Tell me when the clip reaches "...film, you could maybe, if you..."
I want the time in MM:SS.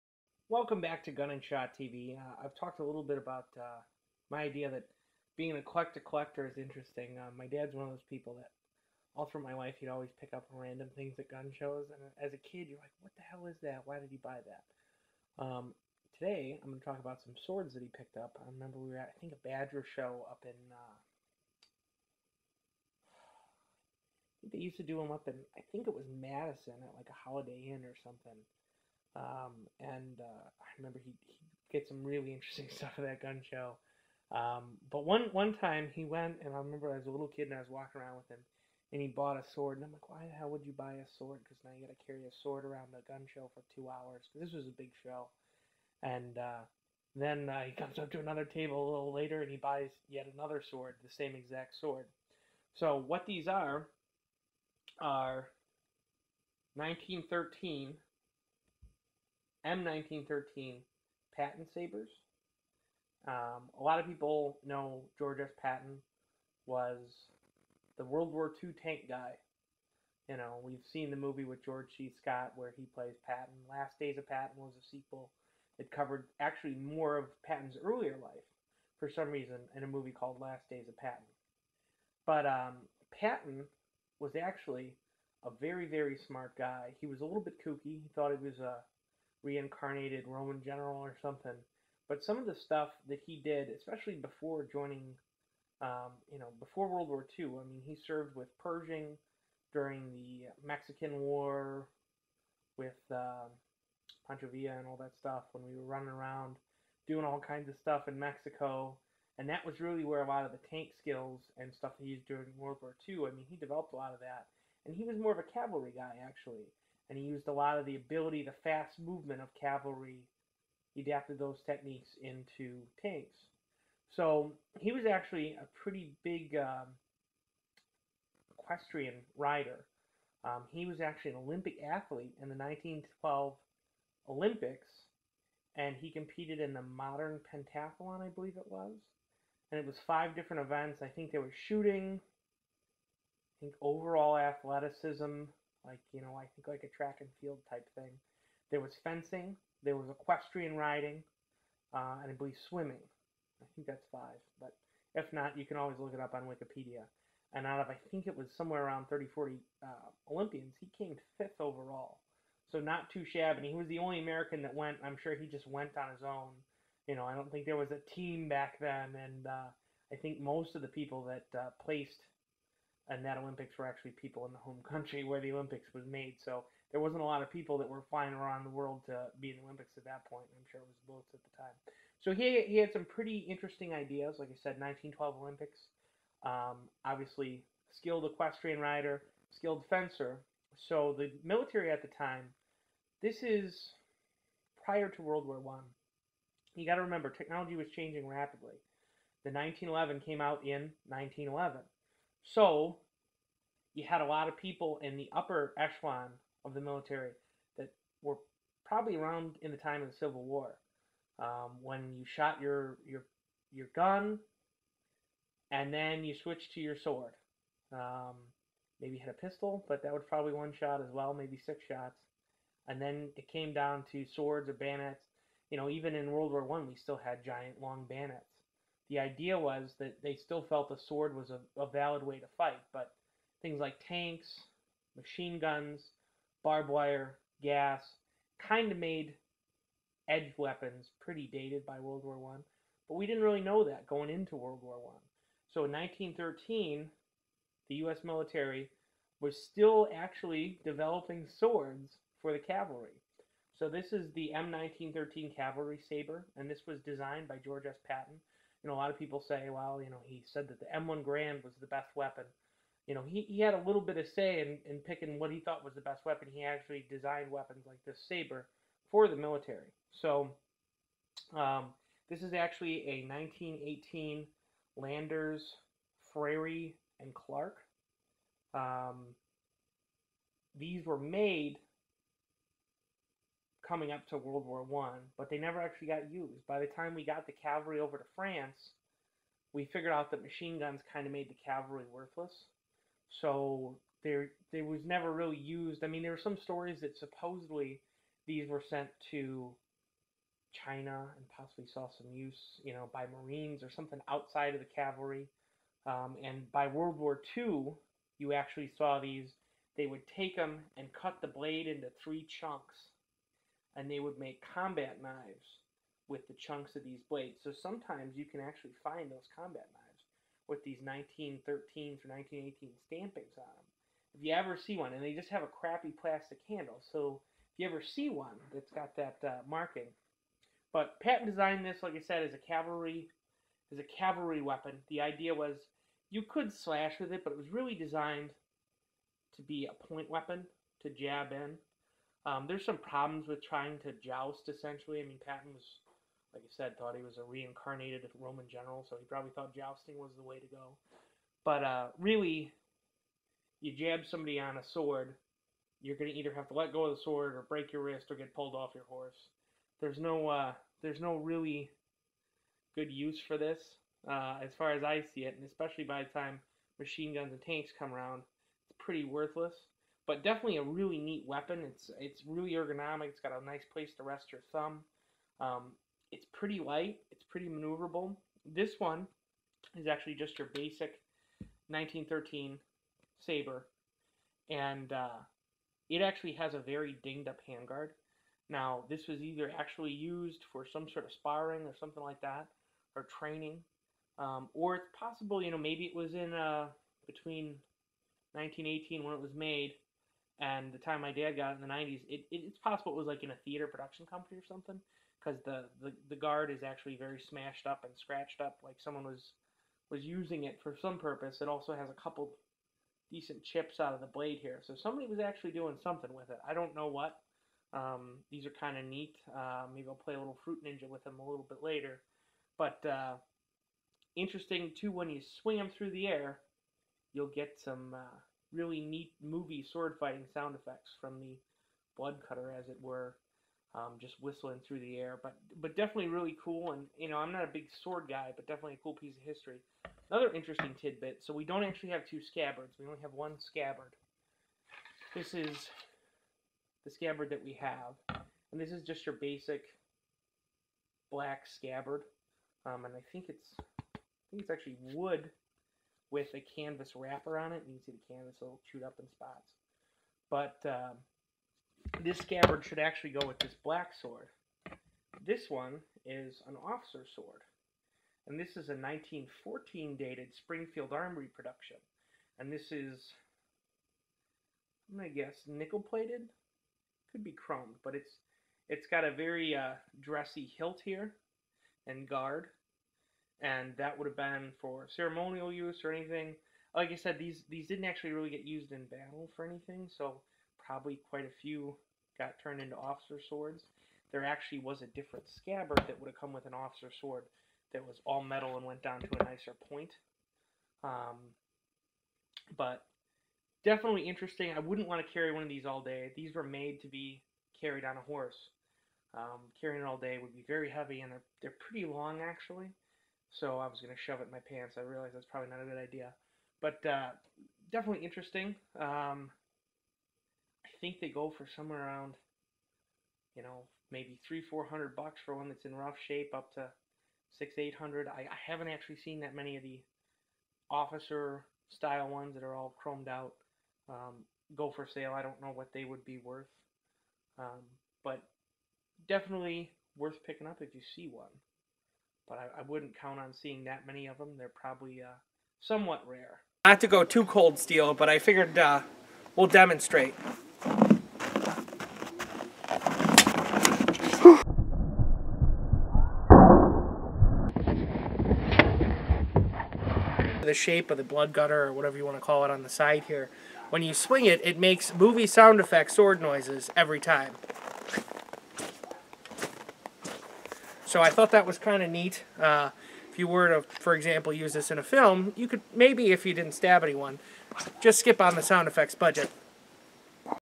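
09:35.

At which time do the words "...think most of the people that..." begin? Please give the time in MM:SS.
02:50.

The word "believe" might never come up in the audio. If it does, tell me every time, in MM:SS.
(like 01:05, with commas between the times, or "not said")
02:18, 02:32.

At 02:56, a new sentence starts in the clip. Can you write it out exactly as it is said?
So there wasn't a lot of people that were flying around the world to be in the Olympics at that point.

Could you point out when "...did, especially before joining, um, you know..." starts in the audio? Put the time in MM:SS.
01:33.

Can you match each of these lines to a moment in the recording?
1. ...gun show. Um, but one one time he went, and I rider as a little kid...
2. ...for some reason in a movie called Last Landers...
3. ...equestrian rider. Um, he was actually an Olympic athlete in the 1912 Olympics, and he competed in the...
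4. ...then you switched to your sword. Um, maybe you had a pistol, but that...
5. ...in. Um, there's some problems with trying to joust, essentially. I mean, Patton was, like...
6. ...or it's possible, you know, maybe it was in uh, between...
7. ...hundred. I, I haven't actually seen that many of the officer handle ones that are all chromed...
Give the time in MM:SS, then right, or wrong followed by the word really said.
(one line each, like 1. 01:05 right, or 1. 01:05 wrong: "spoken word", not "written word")
1. 00:33 wrong: "remember", not "rider"
2. 01:18 wrong: "Days", not "Landers"
3. 02:08 right
4. 03:35 right
5. 05:41 right
6. 06:34 right
7. 08:47 wrong: "style", not "handle".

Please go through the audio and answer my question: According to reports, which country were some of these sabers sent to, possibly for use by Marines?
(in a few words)
China.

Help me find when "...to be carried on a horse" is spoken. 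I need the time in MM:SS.
08:27.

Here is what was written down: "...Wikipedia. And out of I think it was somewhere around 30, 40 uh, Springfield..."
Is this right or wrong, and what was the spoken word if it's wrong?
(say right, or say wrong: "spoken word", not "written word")
wrong: "Olympians", not "Springfield".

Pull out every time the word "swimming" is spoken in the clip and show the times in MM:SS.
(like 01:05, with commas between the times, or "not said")
02:32.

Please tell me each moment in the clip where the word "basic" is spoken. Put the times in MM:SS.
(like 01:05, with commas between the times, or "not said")
06:20, 07:29.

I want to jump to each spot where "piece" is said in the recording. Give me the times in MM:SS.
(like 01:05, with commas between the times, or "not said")
07:19.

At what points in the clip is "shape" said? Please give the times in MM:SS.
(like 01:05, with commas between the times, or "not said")
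08:46, 09:20.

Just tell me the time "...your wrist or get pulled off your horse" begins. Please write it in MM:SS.
05:57.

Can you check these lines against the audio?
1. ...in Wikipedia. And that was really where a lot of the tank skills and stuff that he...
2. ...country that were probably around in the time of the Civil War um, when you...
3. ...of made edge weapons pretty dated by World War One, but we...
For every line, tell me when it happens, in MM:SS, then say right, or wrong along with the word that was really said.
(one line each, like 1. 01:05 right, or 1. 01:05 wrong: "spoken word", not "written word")
1. 01:48 wrong: "Mexico", not "Wikipedia"
2. 03:26 wrong: "military", not "country"
3. 03:58 right.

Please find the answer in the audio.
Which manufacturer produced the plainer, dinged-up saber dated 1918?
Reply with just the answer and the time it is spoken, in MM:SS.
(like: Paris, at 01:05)
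Landers, Frary, and Clark, at 04:34.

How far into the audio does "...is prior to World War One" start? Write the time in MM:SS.
03:13.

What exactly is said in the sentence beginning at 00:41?
Because now you got to carry a sword around a gun show for two hours.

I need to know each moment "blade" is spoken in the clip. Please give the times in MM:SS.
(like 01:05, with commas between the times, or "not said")
05:11, 05:17, 06:54.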